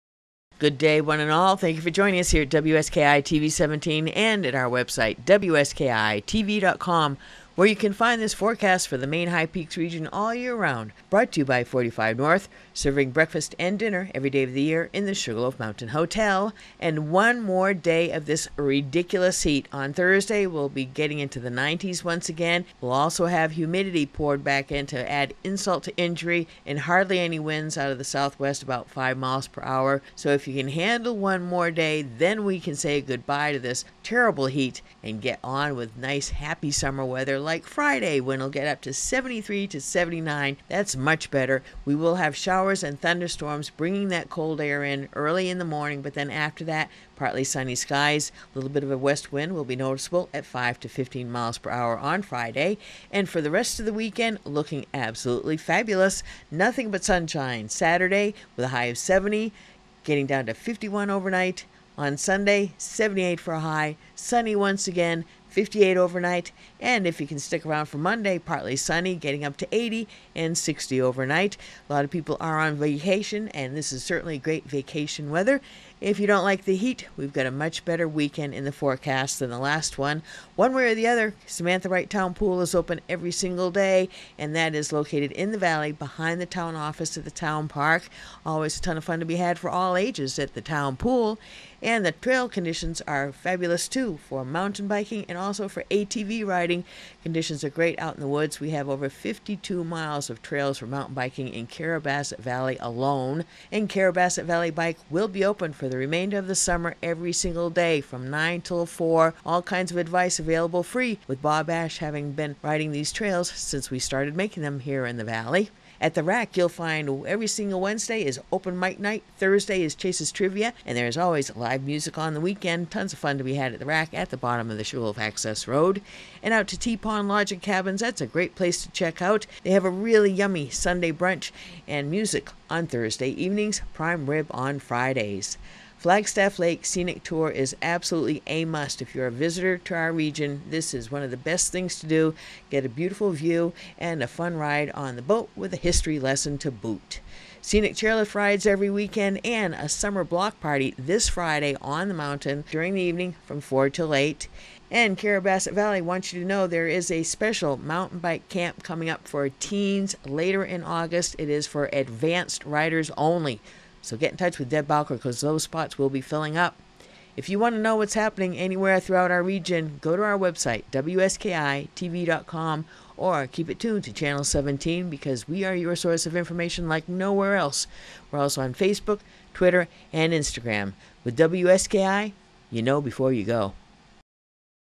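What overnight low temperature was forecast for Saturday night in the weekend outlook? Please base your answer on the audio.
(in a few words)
51.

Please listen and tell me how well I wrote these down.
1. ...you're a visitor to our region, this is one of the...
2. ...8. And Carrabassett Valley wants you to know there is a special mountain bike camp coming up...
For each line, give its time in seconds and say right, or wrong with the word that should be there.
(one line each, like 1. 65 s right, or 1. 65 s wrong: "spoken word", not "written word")
1. 139 s right
2. 154 s right.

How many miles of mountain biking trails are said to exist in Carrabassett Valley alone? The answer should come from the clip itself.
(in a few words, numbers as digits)
over 52.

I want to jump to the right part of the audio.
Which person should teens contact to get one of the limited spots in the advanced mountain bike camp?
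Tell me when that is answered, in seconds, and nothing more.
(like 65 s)
164 s.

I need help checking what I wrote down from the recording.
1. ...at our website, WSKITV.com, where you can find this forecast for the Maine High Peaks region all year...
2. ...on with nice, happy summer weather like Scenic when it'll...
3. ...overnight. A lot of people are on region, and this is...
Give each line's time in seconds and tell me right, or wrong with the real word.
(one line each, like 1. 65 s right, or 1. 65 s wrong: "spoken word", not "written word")
1. 4 s right
2. 35 s wrong: "Friday", not "Scenic"
3. 71 s wrong: "vacation", not "region".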